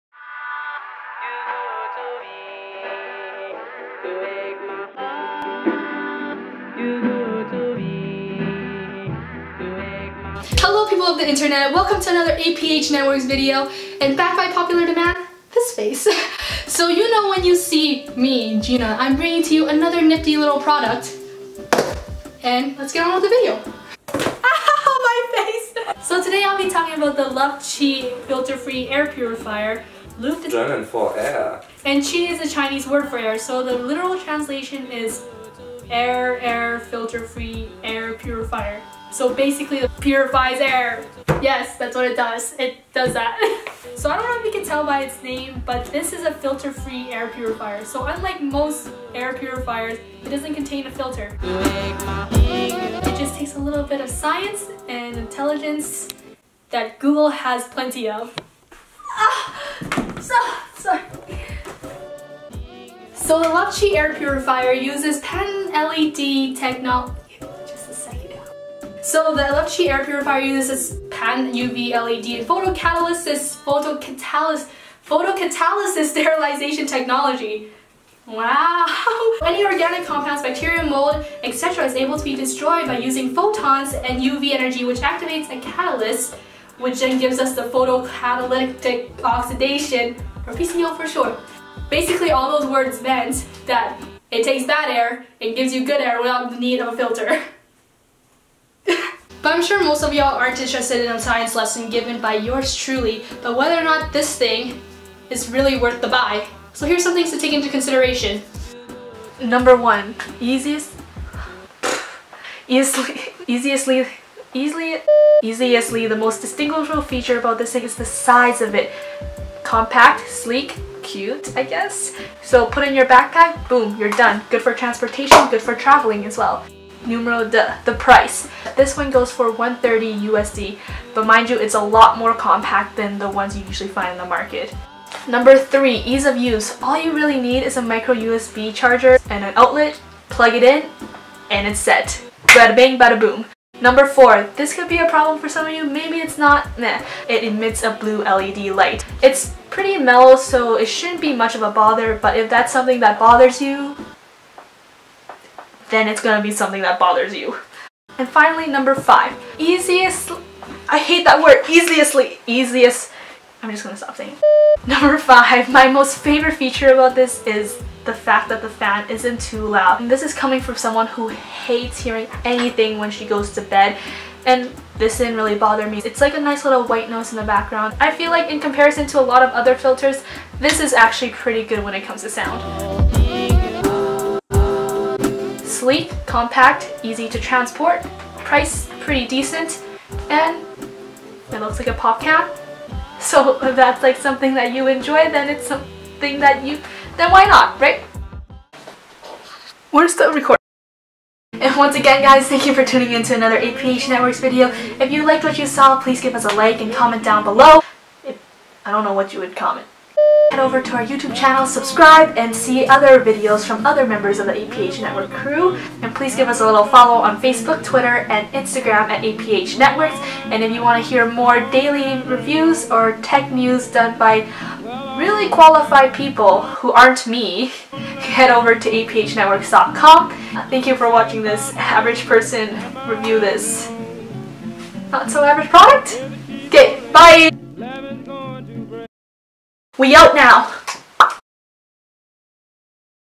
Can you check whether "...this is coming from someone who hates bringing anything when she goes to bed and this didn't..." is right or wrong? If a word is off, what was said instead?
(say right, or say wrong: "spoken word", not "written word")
wrong: "hearing", not "bringing".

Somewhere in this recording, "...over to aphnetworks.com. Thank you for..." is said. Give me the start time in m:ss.
3:48.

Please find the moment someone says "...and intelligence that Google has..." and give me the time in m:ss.
0:54.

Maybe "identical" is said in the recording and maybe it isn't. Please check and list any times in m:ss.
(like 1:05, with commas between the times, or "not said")
not said.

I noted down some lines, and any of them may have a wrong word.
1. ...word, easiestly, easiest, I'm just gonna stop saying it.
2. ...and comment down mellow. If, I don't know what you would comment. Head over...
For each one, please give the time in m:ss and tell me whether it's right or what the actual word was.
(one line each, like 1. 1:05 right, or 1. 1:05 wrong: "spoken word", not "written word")
1. 2:41 right
2. 3:26 wrong: "below", not "mellow".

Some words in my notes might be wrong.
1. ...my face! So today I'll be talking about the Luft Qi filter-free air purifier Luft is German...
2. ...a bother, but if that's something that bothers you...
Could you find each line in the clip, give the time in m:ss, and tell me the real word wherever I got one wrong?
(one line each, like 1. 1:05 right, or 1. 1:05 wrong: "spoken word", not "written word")
1. 0:25 right
2. 2:31 right.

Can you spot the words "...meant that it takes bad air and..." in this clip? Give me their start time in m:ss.
1:33.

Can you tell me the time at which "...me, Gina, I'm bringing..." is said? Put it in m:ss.
0:18.